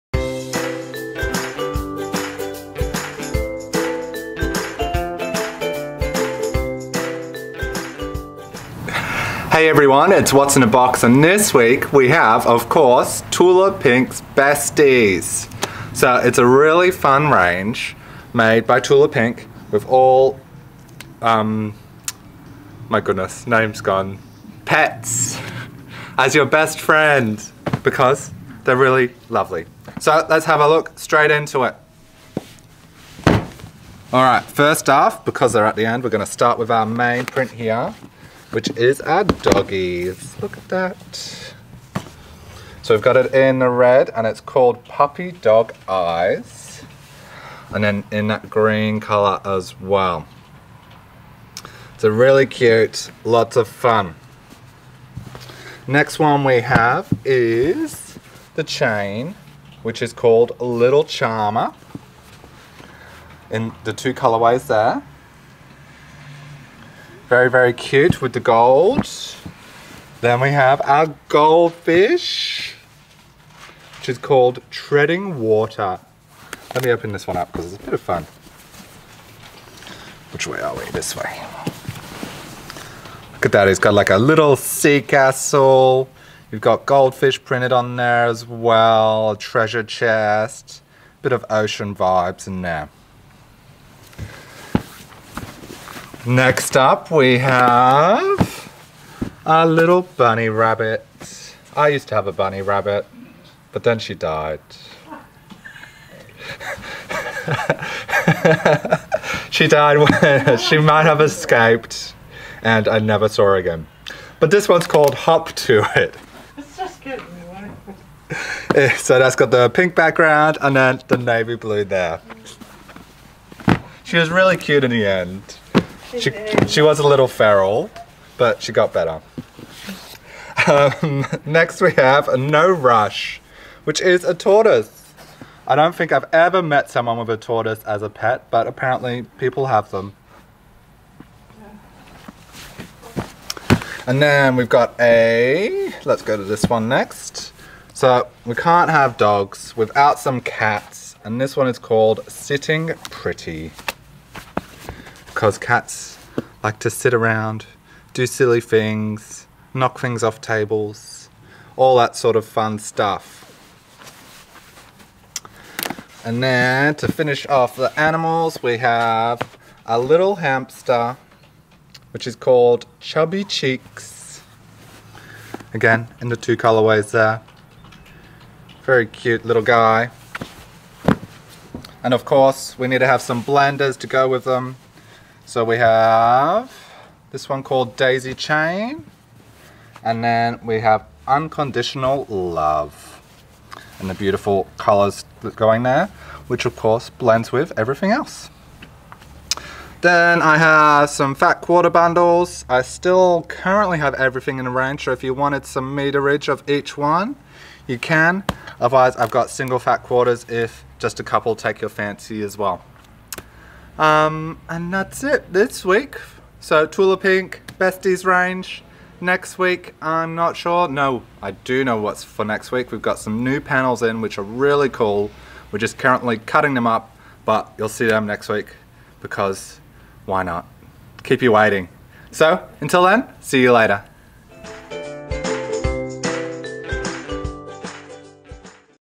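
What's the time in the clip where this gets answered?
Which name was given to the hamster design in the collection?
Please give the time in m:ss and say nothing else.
2:52.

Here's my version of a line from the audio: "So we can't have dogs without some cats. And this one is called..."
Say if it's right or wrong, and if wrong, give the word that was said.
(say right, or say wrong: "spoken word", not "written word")
right.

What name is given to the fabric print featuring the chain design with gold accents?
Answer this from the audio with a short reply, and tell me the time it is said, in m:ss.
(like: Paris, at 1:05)
Little Charmer, at 1:00.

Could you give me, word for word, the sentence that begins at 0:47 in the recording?
And then in that green color as well.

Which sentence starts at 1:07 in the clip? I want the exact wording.
Very, very cute with the gold.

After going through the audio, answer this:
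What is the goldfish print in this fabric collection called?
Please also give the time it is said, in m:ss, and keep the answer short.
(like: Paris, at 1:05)
Treading Water, at 1:14.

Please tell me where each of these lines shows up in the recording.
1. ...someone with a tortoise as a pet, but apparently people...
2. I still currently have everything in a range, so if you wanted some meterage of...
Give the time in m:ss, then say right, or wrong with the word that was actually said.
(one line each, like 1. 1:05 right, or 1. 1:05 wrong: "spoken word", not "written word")
1. 2:16 right
2. 3:22 right.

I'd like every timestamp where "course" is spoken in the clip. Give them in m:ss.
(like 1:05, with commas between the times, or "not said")
0:12, 3:02, 3:16.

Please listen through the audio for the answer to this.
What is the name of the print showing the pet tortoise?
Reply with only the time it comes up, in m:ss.
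2:12.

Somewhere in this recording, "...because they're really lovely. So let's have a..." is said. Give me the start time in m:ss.
0:27.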